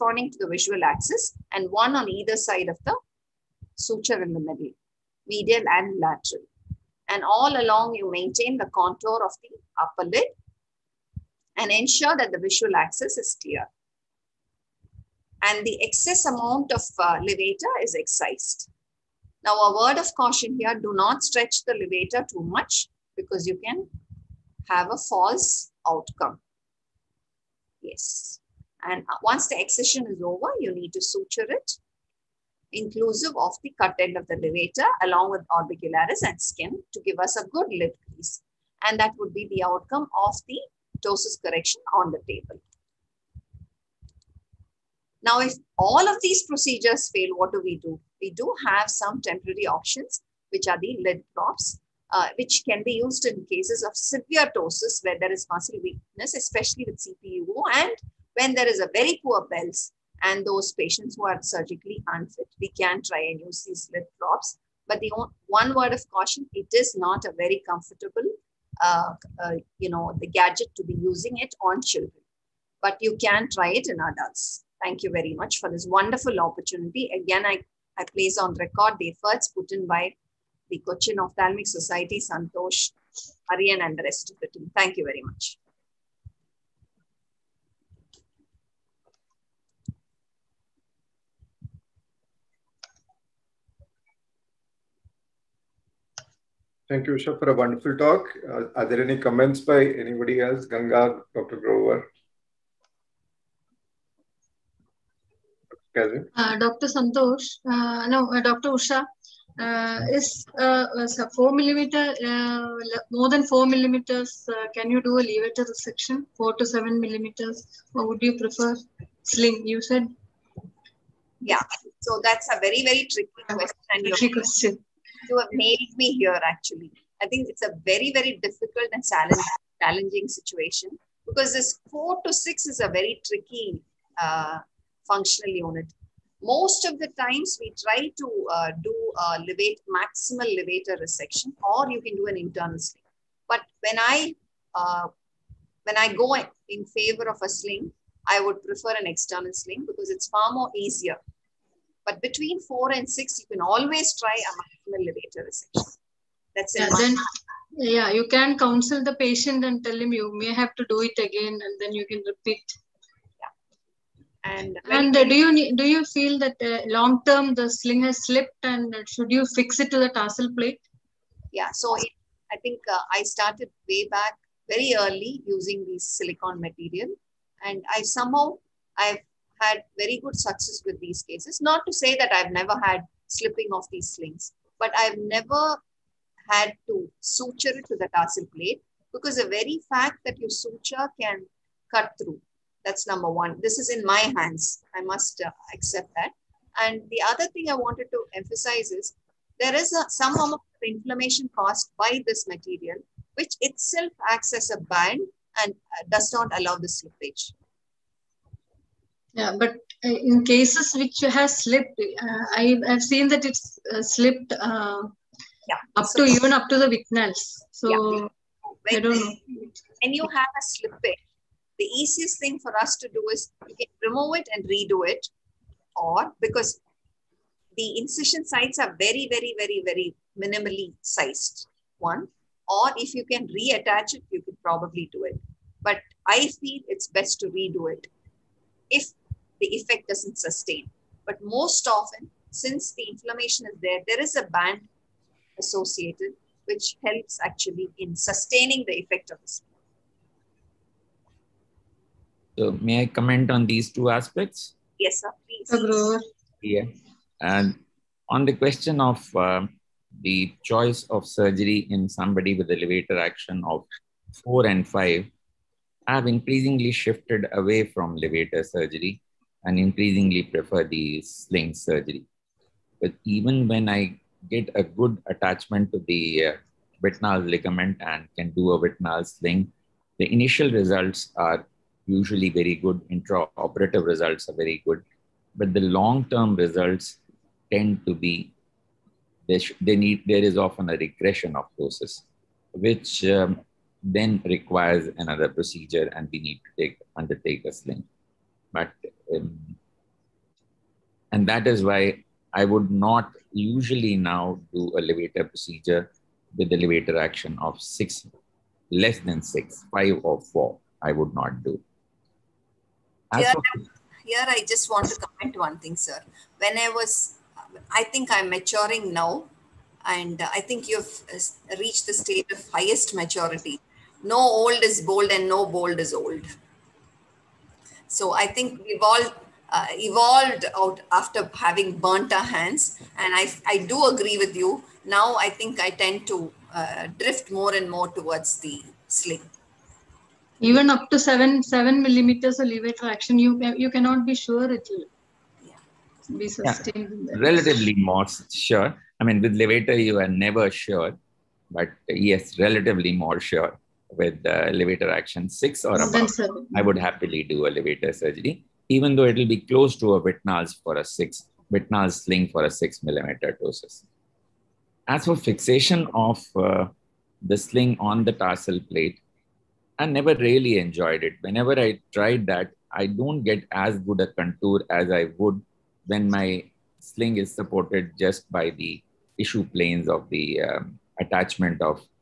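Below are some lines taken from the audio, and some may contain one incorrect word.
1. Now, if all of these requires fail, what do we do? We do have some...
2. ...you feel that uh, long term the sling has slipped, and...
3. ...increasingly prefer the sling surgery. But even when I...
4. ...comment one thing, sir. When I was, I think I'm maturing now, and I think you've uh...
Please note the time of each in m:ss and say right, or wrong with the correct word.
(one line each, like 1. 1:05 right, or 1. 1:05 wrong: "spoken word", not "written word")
1. 0:45 wrong: "procedures", not "requires"
2. 2:45 right
3. 4:29 right
4. 5:15 right.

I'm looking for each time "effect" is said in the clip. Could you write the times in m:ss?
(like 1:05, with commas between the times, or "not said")
3:59, 4:09.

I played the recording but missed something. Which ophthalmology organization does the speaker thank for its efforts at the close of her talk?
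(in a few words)
Cochin Ophthalmic Society.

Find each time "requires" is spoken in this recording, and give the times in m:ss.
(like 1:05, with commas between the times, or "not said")
4:54.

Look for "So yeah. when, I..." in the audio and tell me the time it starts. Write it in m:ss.
3:37.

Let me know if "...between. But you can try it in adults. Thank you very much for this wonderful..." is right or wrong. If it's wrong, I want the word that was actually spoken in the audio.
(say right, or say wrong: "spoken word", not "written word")
wrong: "children", not "between".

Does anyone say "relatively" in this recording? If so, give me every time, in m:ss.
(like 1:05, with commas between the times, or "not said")
5:47, 5:52.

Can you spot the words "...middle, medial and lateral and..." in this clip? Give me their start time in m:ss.
0:04.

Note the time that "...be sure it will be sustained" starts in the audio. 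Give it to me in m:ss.
5:44.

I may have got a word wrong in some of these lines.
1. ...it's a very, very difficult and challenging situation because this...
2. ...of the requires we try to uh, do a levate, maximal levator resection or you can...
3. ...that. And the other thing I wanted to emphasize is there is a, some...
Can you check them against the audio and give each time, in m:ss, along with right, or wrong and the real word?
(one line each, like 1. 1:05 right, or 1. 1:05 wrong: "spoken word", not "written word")
1. 2:07 right
2. 2:16 wrong: "times", not "requires"
3. 3:16 right.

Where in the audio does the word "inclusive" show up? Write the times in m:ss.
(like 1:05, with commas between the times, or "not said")
0:32.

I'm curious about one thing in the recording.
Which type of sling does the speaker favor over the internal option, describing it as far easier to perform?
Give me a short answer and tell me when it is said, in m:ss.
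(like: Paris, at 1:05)
external sling, at 2:29.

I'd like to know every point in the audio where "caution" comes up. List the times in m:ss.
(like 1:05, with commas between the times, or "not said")
0:20, 1:06.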